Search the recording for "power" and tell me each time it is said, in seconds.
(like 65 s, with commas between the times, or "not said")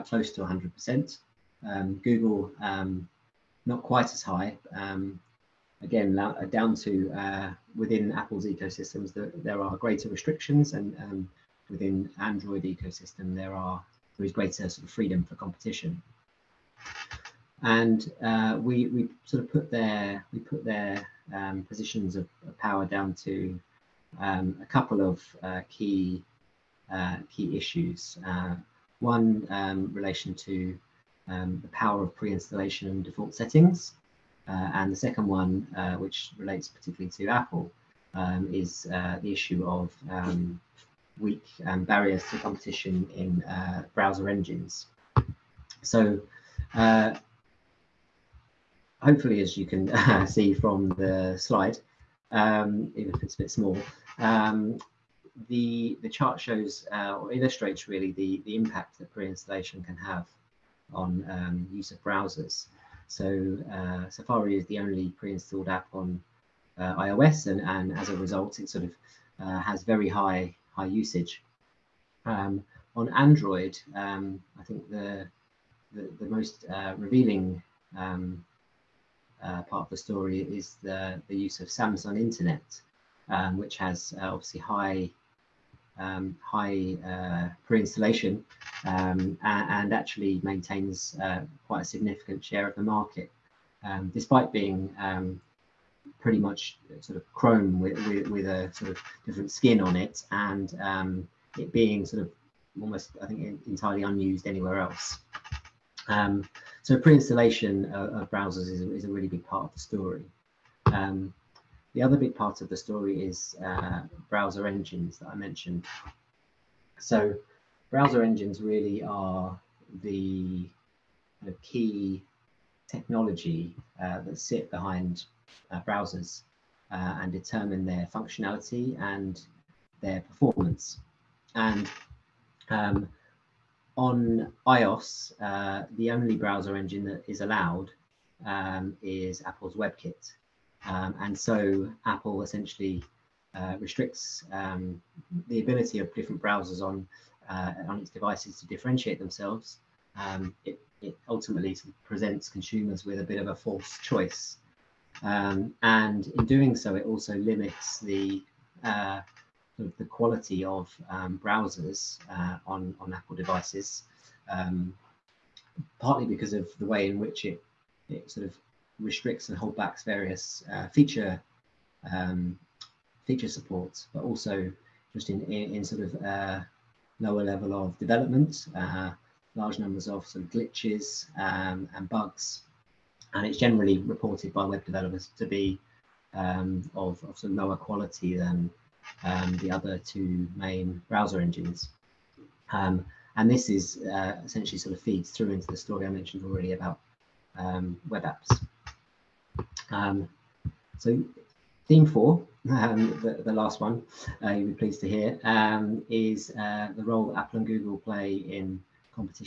22 s, 31 s.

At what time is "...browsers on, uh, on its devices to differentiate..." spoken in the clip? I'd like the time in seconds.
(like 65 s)
146 s.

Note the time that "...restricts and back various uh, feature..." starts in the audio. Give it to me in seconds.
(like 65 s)
168 s.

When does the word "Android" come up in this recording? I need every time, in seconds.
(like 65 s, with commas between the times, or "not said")
12 s, 73 s.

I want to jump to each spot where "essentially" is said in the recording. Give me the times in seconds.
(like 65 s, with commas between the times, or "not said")
142 s, 194 s.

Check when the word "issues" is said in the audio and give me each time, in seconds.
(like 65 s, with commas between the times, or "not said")
27 s, 39 s.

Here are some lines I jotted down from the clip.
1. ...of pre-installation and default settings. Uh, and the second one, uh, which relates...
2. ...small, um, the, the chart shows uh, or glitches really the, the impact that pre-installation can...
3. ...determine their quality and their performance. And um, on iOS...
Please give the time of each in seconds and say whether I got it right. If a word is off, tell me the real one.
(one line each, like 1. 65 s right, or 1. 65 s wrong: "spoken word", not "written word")
1. 32 s right
2. 53 s wrong: "illustrates", not "glitches"
3. 127 s wrong: "functionality", not "quality".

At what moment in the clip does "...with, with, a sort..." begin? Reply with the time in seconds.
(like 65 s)
98 s.